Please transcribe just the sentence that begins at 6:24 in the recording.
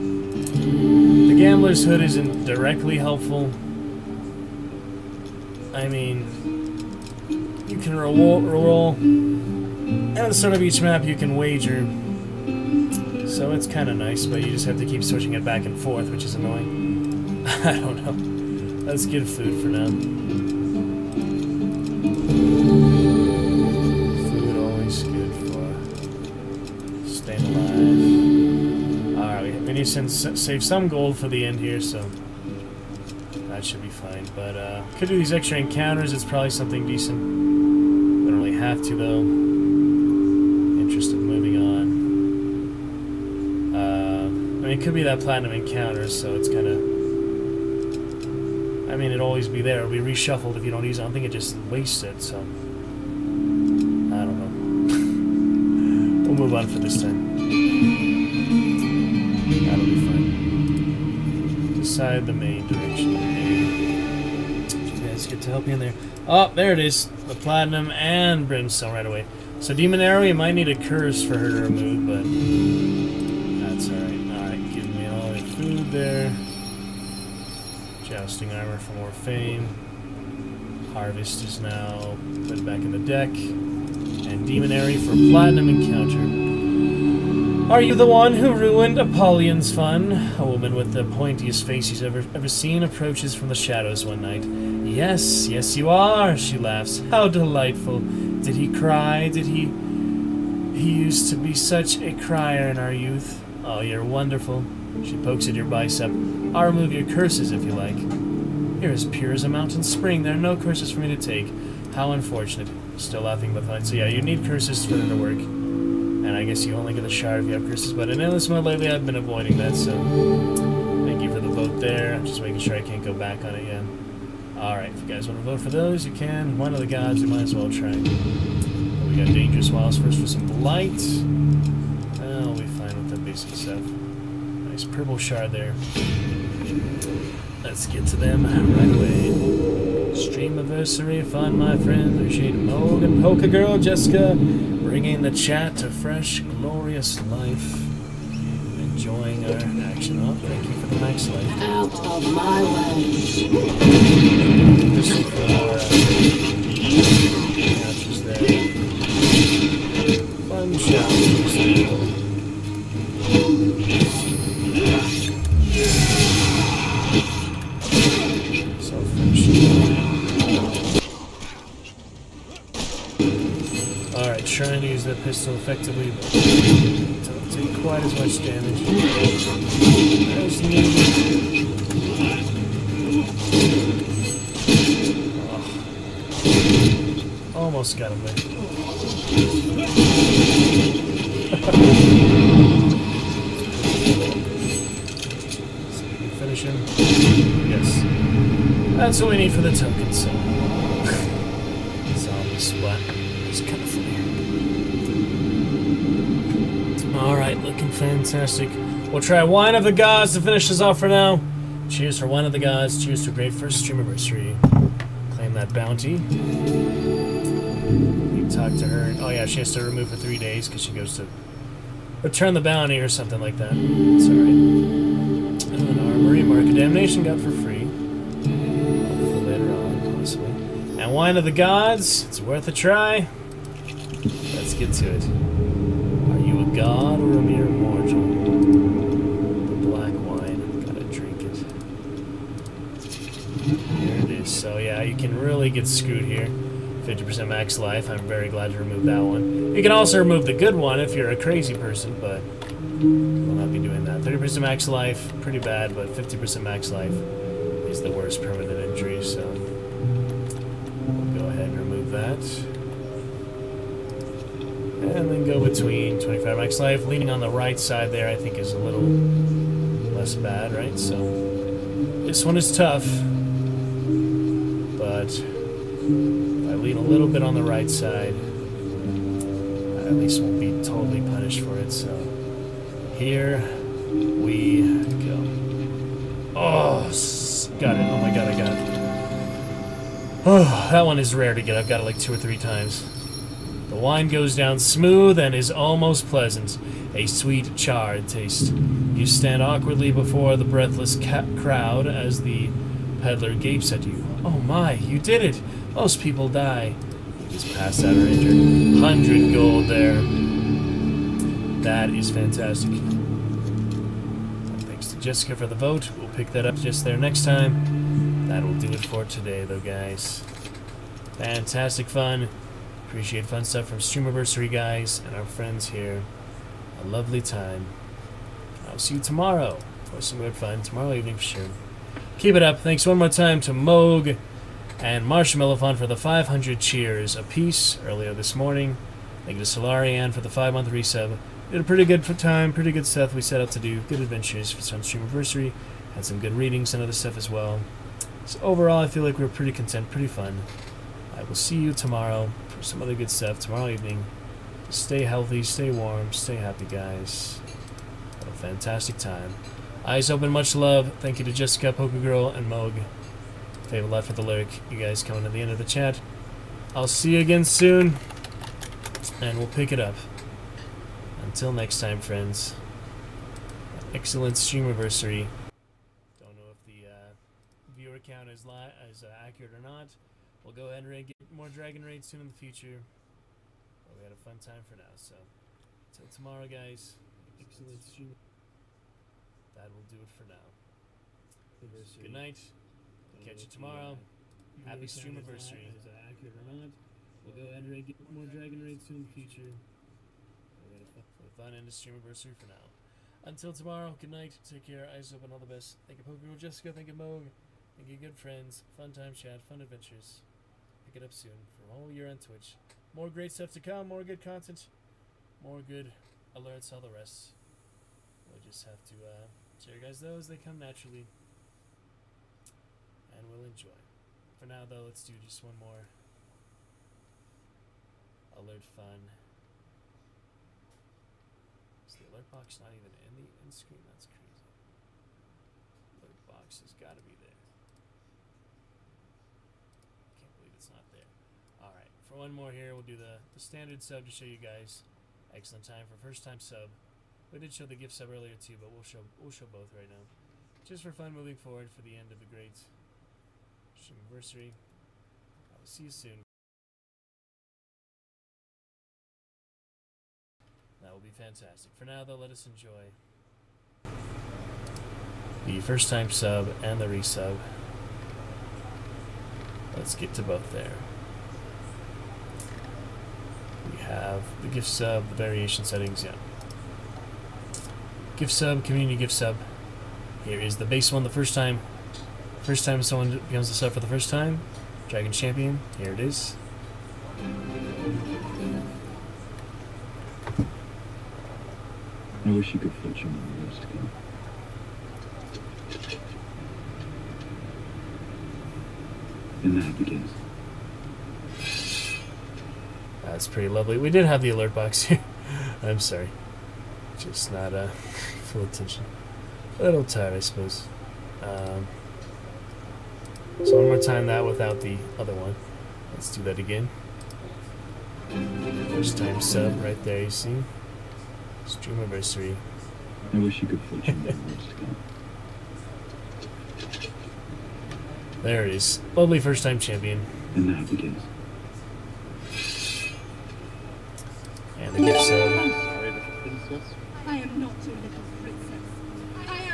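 But we had a fun time for now, so until tomorrow, guys.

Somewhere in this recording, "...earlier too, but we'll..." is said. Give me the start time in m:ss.
7:28.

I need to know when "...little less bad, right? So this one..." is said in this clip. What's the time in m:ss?
4:28.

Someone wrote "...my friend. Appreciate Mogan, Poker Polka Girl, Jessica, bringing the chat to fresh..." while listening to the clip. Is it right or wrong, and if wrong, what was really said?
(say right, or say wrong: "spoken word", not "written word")
right.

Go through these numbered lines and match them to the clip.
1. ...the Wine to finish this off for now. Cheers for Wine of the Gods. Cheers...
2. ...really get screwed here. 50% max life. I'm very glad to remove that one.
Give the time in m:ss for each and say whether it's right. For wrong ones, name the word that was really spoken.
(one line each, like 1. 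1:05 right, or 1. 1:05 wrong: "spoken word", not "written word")
1. 3:29 wrong: "Gods", not "Wine"
2. 4:05 right.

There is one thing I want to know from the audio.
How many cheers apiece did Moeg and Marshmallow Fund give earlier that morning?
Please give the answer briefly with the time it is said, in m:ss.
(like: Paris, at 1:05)
500, at 5:36.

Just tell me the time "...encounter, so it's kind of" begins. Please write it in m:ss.
0:45.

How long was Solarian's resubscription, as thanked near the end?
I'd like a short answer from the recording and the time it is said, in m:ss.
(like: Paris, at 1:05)
5 months, at 5:40.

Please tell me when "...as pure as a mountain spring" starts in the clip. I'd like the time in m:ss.
1:48.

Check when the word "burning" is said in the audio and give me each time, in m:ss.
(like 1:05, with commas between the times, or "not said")
not said.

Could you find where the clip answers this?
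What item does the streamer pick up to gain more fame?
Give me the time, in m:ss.
1:18.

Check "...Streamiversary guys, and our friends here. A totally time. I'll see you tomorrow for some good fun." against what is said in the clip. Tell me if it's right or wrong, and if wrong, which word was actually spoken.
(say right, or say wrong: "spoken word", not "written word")
wrong: "lovely", not "totally".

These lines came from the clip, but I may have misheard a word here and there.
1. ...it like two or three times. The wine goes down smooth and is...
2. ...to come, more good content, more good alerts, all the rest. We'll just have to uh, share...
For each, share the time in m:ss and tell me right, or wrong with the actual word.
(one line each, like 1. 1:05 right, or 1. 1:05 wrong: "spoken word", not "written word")
1. 4:52 right
2. 6:53 right.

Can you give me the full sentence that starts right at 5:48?
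So overall, I feel like we are pretty content, pretty fun.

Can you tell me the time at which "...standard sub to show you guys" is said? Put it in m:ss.
7:23.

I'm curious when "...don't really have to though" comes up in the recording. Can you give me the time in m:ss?
0:38.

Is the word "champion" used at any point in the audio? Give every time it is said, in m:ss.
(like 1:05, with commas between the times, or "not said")
8:05, 8:49.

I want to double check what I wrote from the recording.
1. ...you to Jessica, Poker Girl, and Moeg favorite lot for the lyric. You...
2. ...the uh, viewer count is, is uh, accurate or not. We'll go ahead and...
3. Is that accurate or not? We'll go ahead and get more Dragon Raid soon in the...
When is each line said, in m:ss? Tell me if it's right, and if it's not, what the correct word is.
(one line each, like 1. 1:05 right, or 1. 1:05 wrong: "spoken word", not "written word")
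1. 6:01 right
2. 6:16 right
3. 6:35 right.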